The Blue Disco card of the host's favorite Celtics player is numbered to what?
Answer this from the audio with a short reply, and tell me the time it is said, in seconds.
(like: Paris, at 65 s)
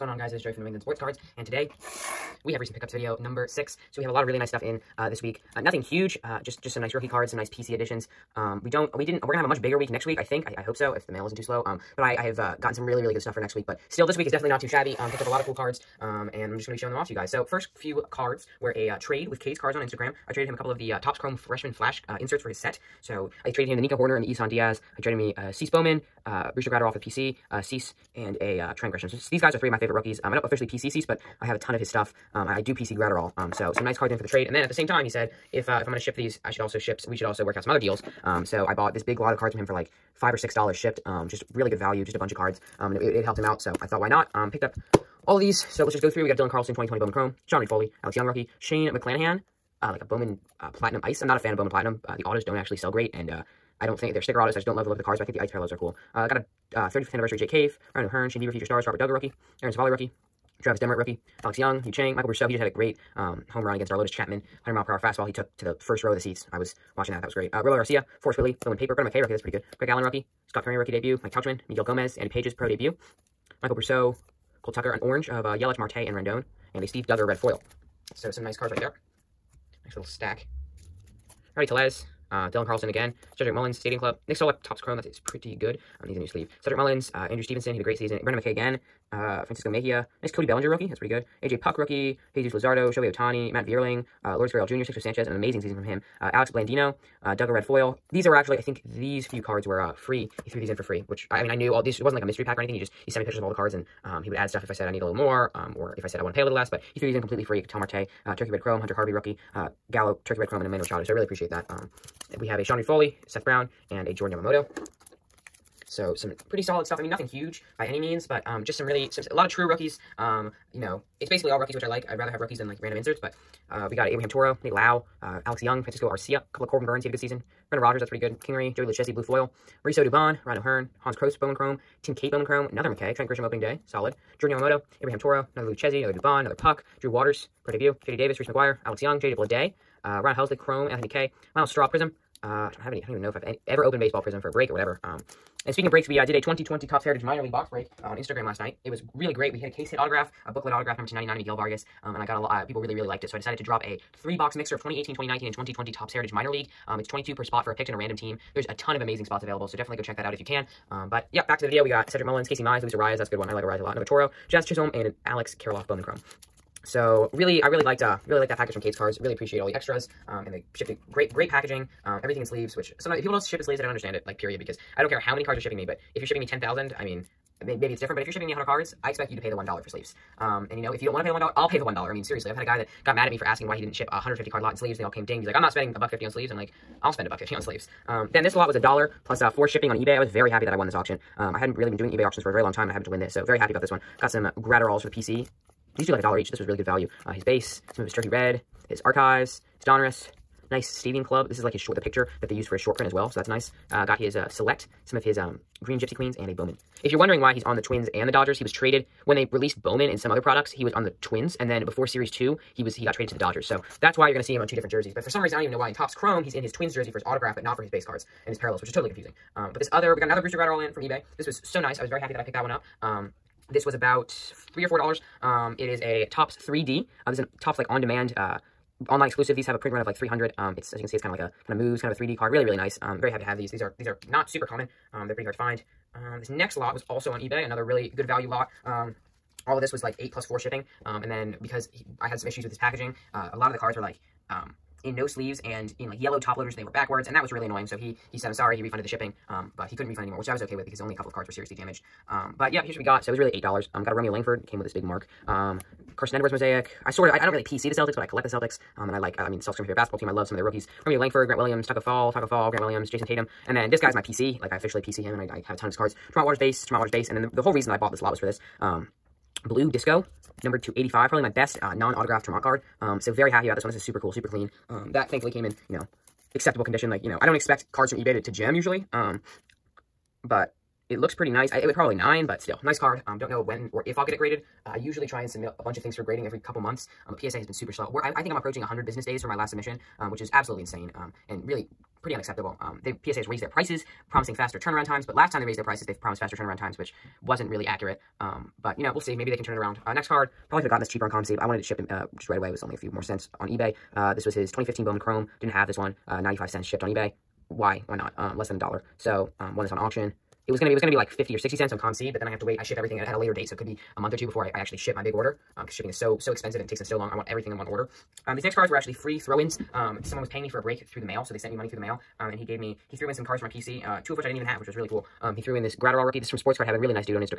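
85, at 270 s.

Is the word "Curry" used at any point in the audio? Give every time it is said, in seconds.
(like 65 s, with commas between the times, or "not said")
70 s.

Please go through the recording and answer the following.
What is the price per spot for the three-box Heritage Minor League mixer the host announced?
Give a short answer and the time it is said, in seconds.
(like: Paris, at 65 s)
22, at 157 s.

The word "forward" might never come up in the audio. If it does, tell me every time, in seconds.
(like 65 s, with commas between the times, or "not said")
not said.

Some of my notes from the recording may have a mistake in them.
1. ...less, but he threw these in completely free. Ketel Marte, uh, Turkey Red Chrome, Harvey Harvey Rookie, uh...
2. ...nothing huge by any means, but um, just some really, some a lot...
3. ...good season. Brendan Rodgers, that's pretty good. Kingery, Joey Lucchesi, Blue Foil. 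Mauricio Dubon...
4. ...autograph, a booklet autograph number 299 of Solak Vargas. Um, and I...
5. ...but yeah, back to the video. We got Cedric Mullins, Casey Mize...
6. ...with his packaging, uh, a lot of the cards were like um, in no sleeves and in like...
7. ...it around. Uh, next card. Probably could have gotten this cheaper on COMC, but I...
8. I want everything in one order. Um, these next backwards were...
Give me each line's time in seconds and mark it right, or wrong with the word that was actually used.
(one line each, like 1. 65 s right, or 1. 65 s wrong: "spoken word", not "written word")
1. 106 s wrong: "Hunter", not "Harvey"
2. 117 s right
3. 127 s right
4. 149 s wrong: "Miguel", not "Solak"
5. 161 s right
6. 242 s right
7. 299 s right
8. 317 s wrong: "cards", not "backwards".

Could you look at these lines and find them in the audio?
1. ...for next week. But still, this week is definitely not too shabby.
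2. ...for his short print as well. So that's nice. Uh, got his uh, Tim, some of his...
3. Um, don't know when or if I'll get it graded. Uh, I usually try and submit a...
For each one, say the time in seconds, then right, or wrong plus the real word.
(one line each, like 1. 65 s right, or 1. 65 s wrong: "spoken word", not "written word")
1. 13 s right
2. 202 s wrong: "Select", not "Tim"
3. 283 s right.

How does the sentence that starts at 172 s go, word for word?
Um, everything in sleeves, which sometimes if people don't ship in sleeves, I don't understand it.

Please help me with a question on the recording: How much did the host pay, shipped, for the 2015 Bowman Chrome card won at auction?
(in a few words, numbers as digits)
95 cents.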